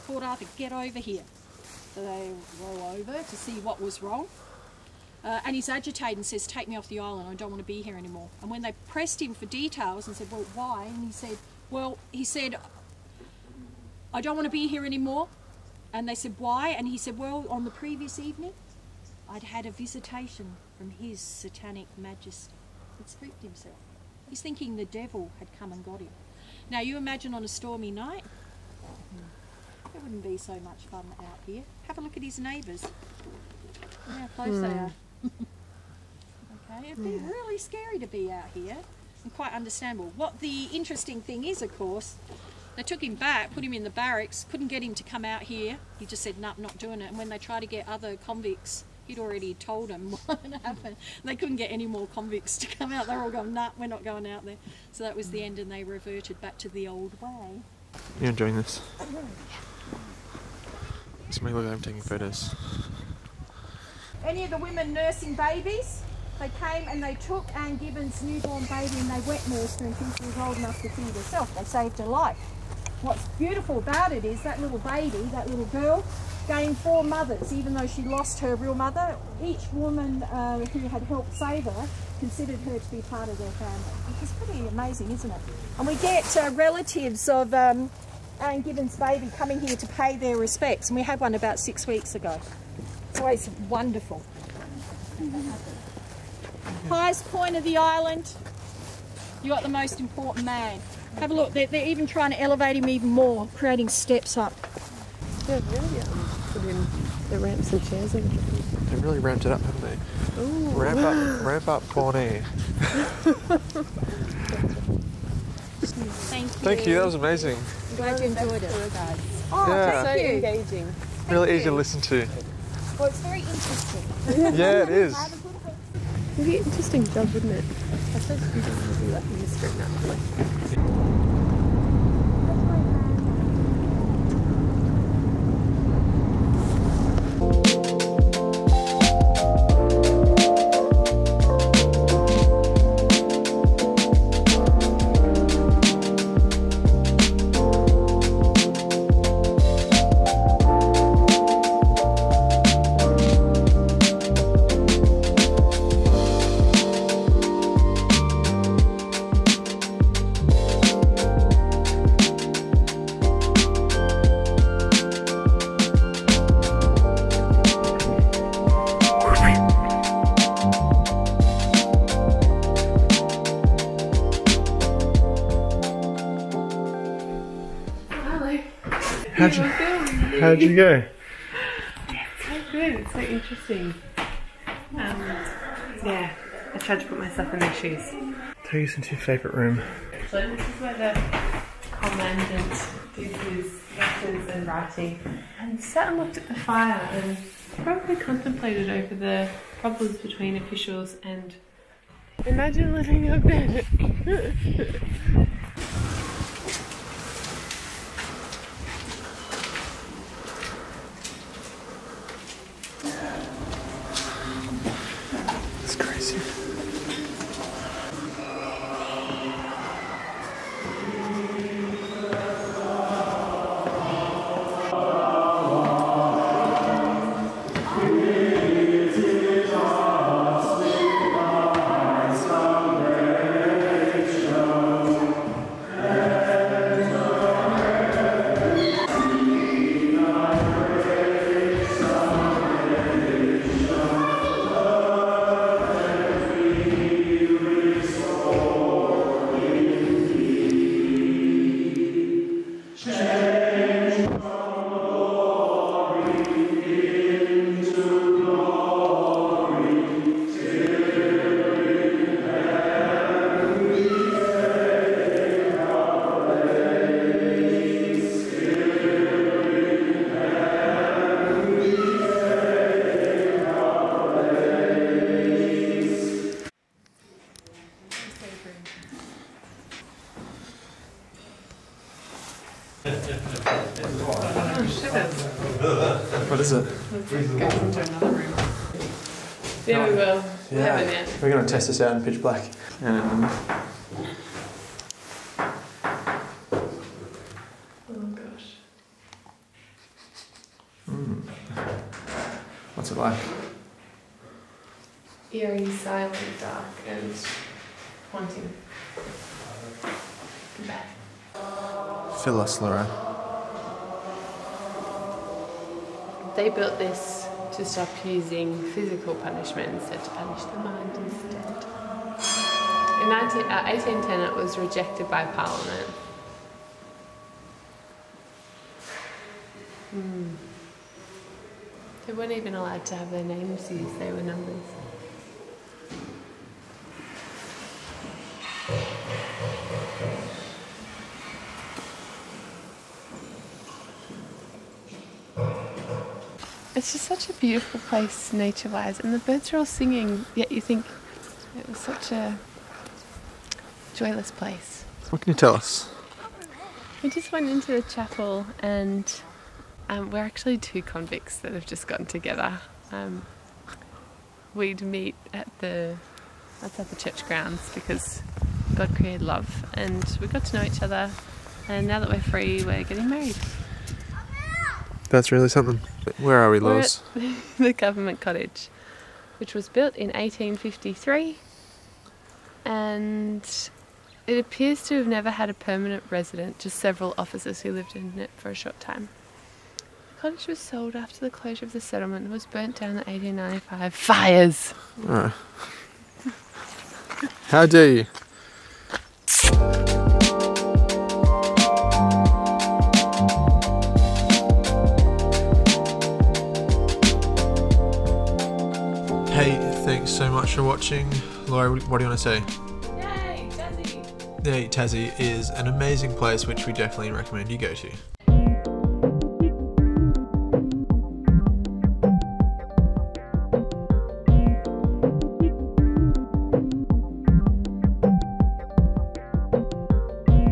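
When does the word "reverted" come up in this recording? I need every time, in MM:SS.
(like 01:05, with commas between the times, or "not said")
00:55.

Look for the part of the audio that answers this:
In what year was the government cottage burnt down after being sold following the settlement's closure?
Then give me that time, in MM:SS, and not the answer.
06:33.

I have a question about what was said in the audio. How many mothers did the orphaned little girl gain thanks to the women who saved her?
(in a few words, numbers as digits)
4.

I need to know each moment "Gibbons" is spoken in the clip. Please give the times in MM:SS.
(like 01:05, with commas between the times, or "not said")
01:07, 01:28.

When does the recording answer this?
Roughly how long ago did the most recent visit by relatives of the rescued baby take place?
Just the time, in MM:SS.
01:31.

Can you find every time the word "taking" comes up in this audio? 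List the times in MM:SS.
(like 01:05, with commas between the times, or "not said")
01:01.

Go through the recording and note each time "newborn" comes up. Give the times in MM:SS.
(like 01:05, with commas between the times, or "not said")
01:08.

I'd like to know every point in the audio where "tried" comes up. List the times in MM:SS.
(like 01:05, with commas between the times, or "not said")
00:47, 03:06.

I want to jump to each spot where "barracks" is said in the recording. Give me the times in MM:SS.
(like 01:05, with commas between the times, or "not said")
00:43.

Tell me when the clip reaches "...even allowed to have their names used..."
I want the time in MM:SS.
05:32.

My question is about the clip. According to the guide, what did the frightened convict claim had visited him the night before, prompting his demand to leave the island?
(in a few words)
His satanic majesty.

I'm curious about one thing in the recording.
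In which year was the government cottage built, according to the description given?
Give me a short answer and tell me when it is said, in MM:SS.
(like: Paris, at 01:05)
1853, at 06:20.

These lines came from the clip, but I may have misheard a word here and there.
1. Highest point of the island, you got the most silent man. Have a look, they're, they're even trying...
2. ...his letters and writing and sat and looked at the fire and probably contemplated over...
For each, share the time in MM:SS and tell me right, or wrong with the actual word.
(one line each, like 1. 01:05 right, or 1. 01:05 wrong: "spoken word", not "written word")
1. 01:36 wrong: "important", not "silent"
2. 03:13 right.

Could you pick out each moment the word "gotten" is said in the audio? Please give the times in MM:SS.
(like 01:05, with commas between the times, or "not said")
06:02.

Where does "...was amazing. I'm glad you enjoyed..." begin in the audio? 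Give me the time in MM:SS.
01:57.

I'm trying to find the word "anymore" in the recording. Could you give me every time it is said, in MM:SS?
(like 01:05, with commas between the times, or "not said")
00:07, 00:14.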